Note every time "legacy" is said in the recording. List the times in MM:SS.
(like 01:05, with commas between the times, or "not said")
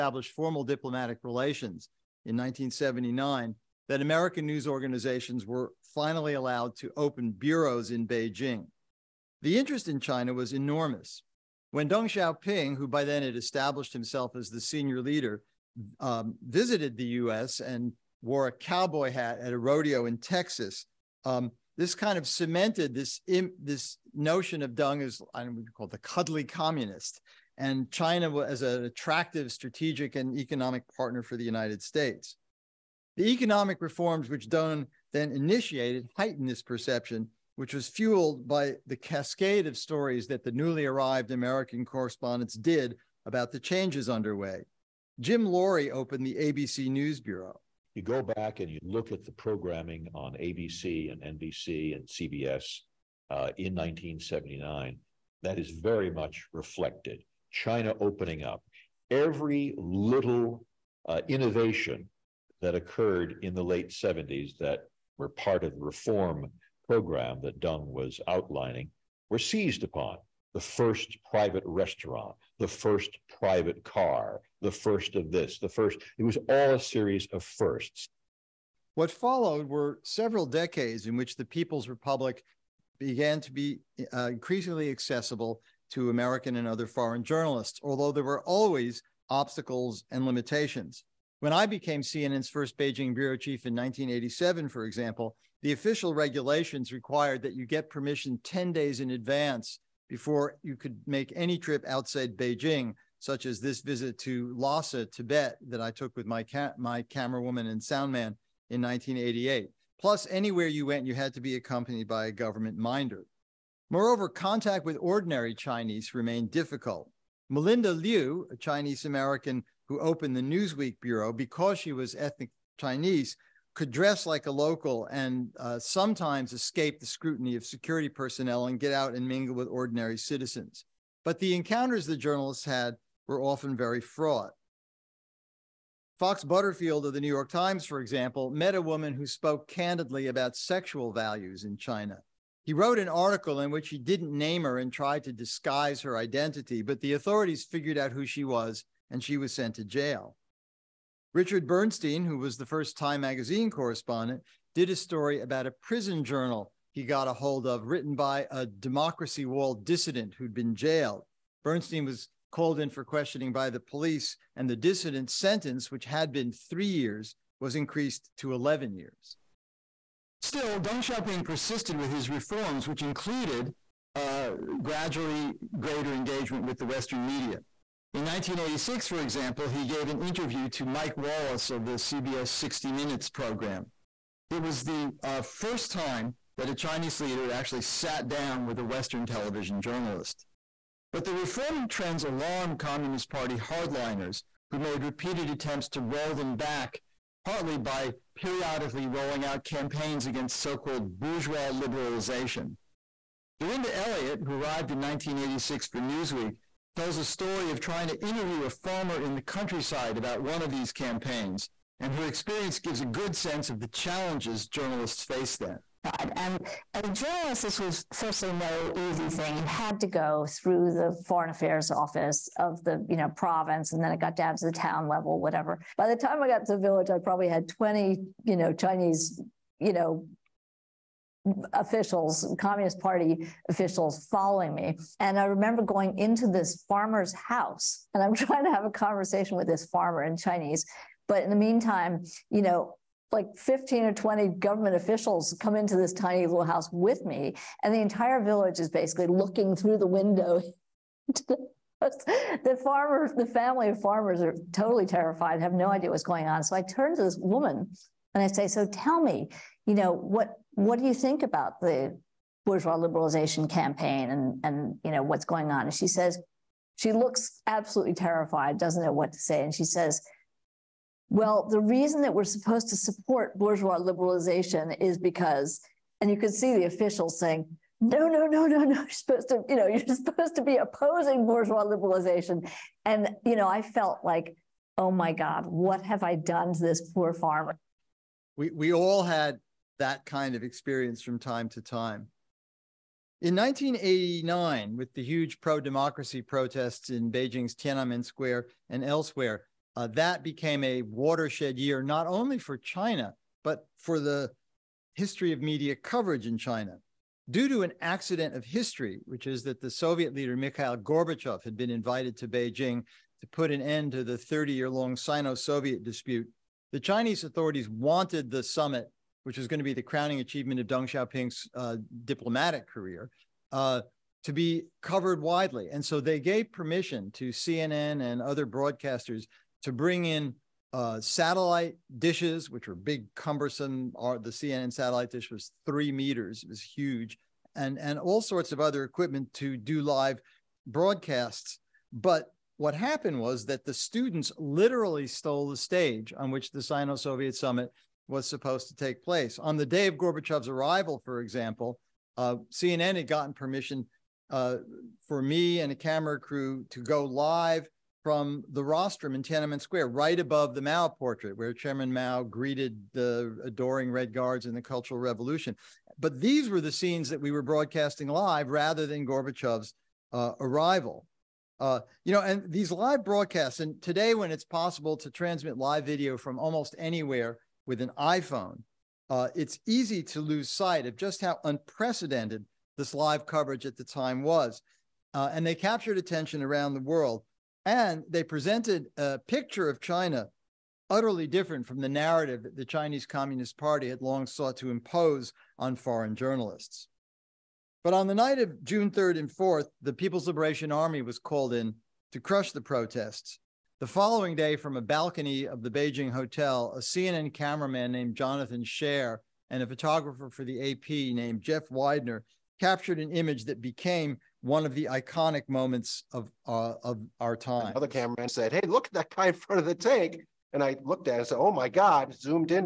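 not said.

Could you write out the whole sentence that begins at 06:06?
But these were the scenes that we were broadcasting live rather than Gorbachev's uh, arrival.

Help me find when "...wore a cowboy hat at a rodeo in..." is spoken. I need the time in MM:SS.
00:18.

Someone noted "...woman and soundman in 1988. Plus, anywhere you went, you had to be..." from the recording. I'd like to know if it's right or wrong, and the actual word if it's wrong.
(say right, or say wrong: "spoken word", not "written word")
right.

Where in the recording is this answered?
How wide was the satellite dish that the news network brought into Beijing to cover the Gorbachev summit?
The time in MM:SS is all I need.
05:35.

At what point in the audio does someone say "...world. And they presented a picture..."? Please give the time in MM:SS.
06:26.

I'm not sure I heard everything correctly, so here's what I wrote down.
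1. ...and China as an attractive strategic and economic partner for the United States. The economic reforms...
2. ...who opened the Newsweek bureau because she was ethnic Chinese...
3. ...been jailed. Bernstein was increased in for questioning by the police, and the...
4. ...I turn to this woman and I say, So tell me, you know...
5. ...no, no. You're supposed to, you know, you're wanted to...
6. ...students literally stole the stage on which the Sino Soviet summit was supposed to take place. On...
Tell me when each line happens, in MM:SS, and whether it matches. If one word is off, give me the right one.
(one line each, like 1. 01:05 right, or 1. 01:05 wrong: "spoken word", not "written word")
1. 00:27 right
2. 01:59 right
3. 02:40 wrong: "called", not "increased"
4. 04:16 right
5. 04:38 wrong: "supposed", not "wanted"
6. 05:43 right.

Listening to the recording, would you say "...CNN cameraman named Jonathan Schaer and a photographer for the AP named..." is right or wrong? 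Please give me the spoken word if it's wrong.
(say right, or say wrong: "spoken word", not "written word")
right.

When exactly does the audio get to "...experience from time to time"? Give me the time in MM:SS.
04:50.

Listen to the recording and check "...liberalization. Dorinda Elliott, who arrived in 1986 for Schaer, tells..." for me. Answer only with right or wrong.
wrong.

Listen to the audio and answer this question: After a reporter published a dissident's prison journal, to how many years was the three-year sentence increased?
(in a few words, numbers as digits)
11.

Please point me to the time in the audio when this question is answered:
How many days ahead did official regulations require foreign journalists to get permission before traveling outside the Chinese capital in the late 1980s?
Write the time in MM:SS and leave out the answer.
01:38.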